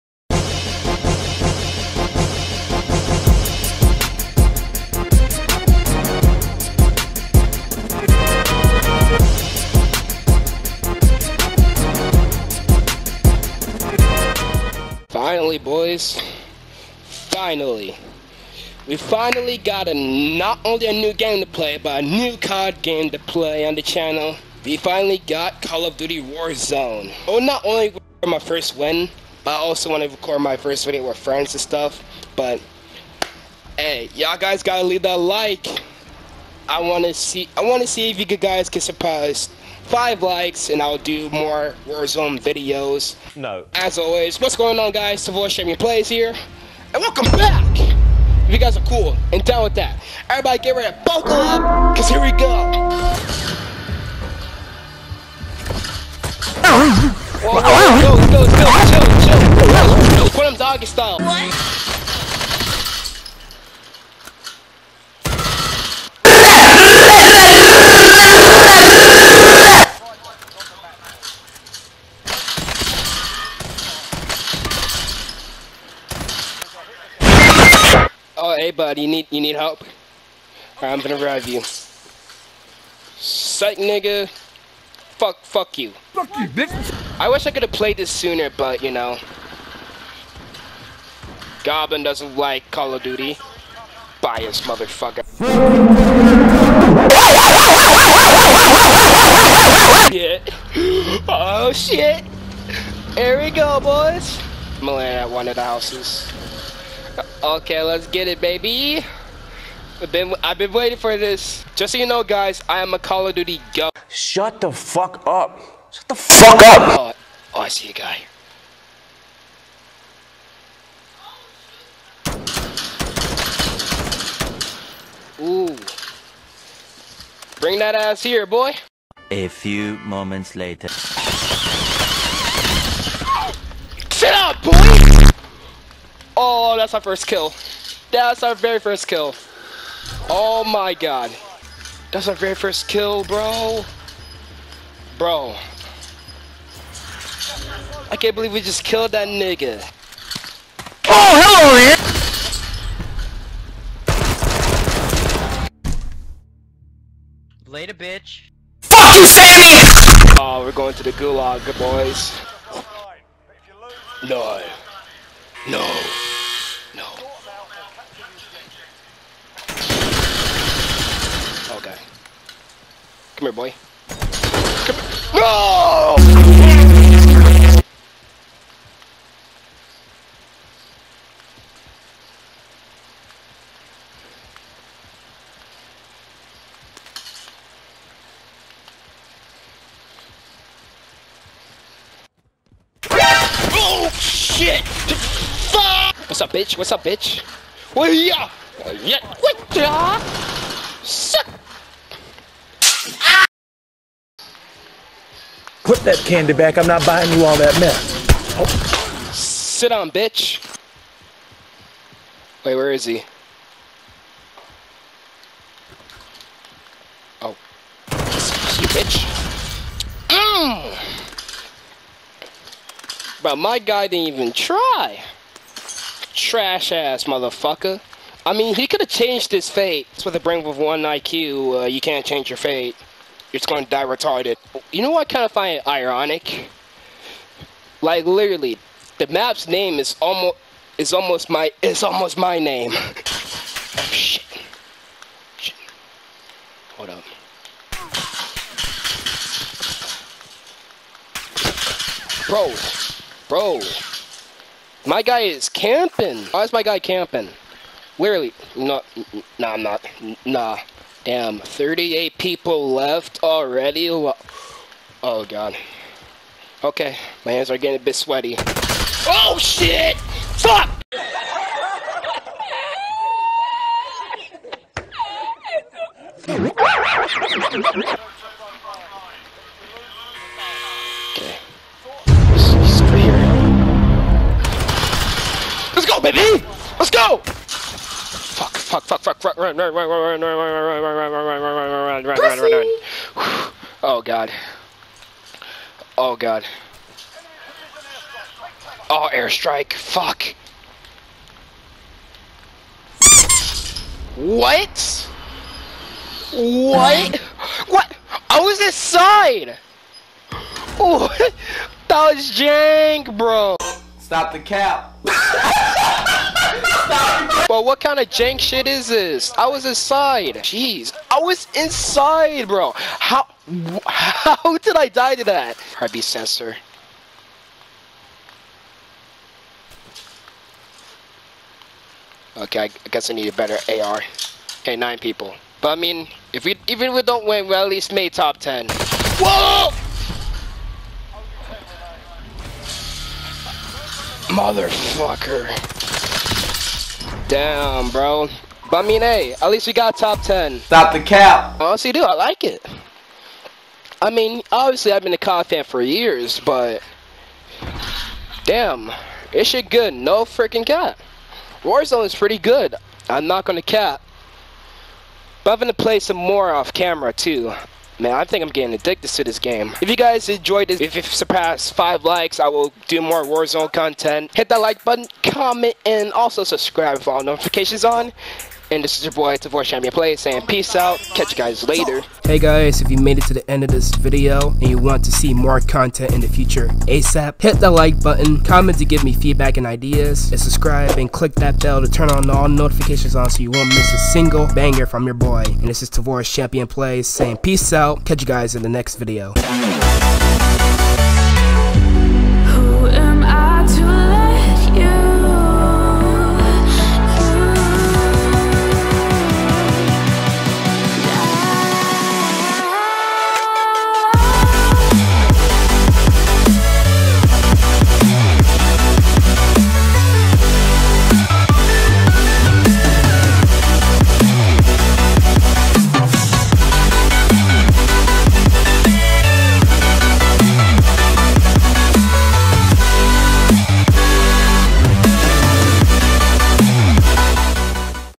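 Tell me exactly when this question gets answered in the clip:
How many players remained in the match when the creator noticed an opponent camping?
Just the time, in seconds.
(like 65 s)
261 s.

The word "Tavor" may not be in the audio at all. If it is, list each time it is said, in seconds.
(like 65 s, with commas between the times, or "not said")
379 s, 396 s.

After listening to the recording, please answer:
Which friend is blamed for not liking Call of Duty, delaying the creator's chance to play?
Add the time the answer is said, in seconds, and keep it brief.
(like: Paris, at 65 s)
Goblin, at 91 s.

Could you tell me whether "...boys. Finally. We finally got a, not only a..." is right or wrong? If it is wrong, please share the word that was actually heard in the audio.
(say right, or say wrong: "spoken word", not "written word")
right.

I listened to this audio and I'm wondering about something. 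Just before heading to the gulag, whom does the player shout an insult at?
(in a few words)
Sammy.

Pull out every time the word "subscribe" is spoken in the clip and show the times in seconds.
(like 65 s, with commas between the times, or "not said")
376 s, 390 s.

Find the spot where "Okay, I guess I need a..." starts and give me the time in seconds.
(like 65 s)
332 s.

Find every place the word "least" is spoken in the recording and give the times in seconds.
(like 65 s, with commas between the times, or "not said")
337 s, 349 s.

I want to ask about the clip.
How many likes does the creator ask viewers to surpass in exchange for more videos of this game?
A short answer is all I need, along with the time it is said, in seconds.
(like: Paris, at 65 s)
5, at 39 s.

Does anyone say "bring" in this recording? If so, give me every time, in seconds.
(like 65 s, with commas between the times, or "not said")
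127 s, 230 s.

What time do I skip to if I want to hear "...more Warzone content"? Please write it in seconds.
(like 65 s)
373 s.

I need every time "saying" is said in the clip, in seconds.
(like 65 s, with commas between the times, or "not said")
380 s, 397 s.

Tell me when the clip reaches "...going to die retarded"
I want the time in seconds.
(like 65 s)
233 s.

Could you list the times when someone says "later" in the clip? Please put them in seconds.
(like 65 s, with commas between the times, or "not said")
130 s, 157 s, 381 s.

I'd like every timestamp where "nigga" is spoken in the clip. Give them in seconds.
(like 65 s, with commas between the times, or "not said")
83 s, 149 s.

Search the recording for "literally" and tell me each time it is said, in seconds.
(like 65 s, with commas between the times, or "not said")
238 s, 258 s.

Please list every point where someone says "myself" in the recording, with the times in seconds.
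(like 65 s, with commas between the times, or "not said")
not said.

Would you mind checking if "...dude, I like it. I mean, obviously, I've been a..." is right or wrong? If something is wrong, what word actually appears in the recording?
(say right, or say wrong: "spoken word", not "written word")
right.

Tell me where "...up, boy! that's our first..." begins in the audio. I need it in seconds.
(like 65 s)
134 s.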